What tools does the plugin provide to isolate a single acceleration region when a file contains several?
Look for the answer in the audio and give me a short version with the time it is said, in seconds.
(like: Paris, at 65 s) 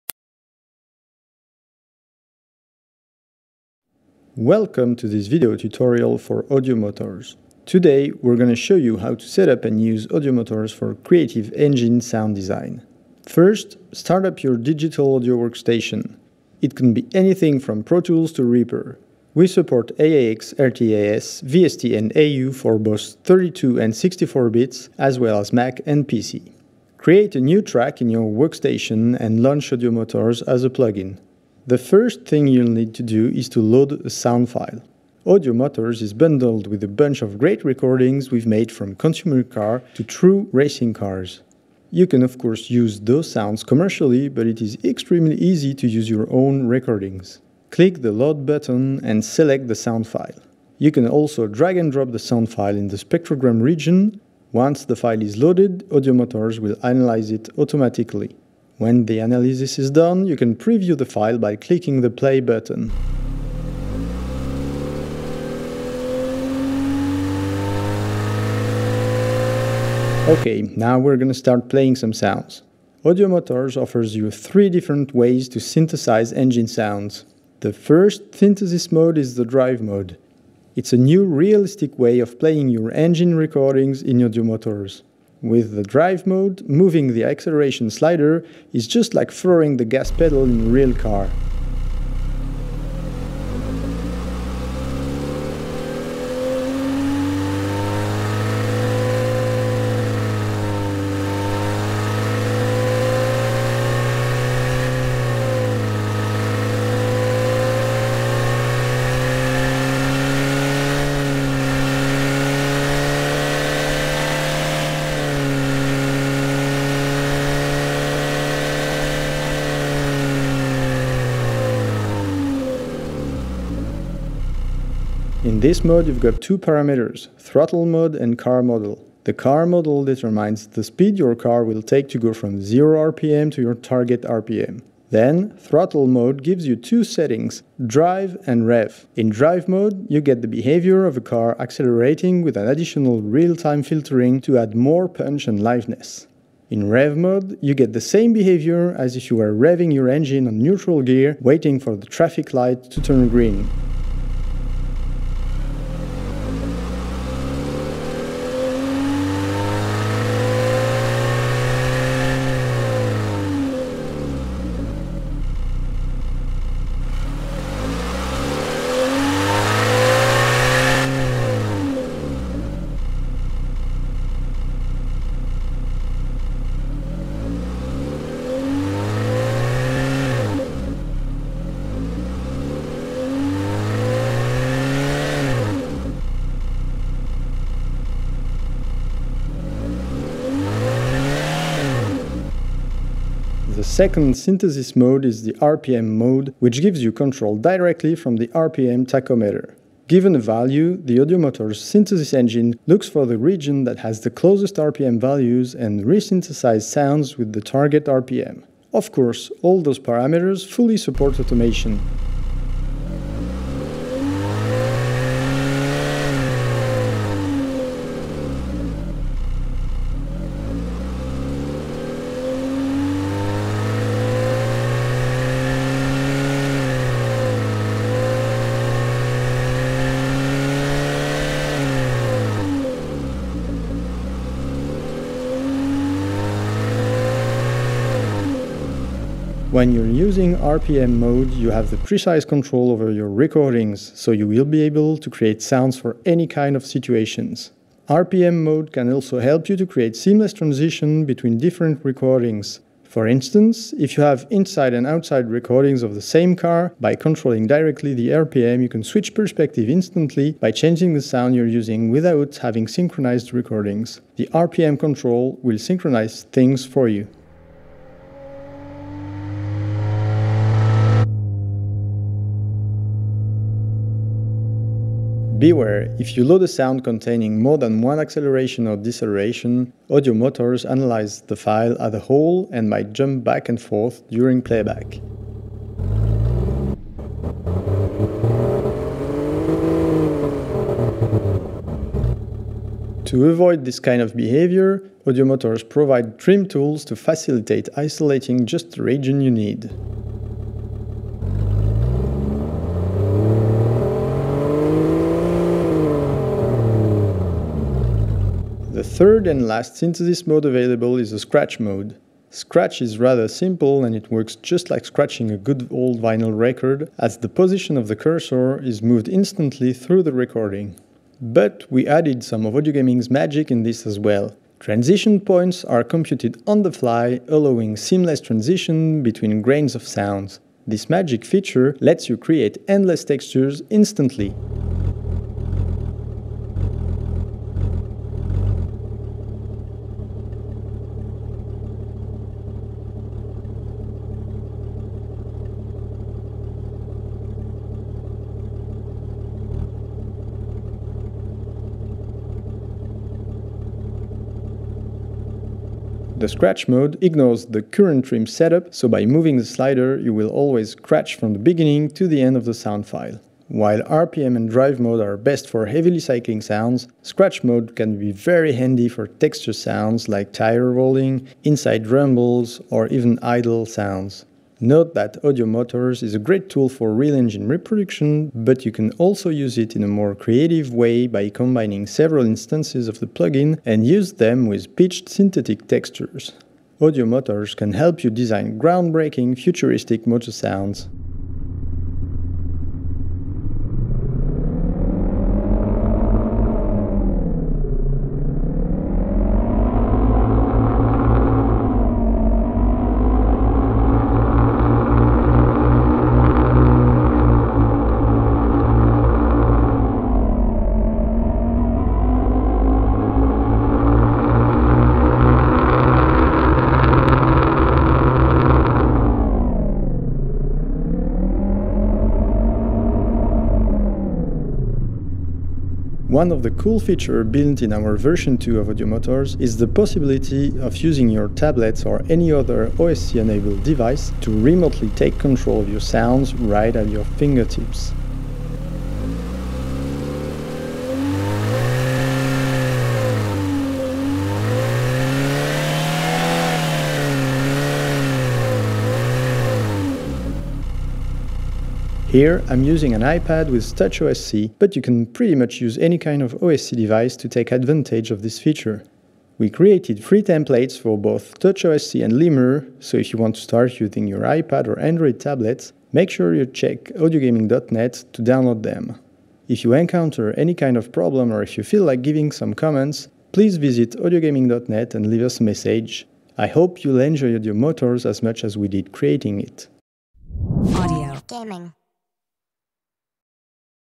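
trim tools, at 296 s.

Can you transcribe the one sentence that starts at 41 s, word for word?
You can of course use those sounds commercially, but it is extremely easy to use your own recordings.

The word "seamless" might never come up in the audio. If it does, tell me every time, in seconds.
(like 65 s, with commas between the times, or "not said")
250 s, 327 s.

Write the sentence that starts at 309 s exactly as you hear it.
third and last synthesis mode available is the scratch mode.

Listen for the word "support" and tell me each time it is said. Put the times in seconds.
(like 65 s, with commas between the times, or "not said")
19 s, 210 s.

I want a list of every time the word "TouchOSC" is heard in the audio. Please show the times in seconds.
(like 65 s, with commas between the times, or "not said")
453 s, 461 s.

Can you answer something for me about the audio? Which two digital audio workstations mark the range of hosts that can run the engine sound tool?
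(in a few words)
Pro Tools to Reaper.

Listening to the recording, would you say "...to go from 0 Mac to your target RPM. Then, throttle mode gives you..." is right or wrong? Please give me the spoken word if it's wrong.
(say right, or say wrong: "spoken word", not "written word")
wrong: "RPM", not "Mac".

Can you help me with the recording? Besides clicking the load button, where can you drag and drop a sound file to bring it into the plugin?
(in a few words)
spectrogram region.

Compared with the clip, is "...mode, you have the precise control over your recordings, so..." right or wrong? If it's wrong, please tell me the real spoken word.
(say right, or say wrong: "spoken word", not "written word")
right.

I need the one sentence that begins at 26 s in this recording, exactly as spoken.
Create a new track in your workstation and launch Audiomotors as a plugin.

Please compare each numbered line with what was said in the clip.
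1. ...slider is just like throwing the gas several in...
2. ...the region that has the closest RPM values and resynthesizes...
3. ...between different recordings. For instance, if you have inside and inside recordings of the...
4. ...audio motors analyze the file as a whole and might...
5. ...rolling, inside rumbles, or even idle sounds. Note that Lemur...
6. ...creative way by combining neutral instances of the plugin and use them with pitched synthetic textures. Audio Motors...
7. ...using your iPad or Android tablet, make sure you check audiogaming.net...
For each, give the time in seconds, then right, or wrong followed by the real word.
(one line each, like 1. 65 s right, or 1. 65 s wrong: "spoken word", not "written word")
1. 87 s wrong: "pedal", not "several"
2. 203 s right
3. 251 s wrong: "outside", not "inside"
4. 280 s right
5. 370 s wrong: "Audio", not "Lemur"
6. 380 s wrong: "several", not "neutral"
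7. 463 s right.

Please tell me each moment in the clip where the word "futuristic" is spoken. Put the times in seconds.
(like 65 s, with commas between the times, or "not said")
389 s.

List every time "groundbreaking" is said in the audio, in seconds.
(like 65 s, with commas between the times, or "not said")
388 s.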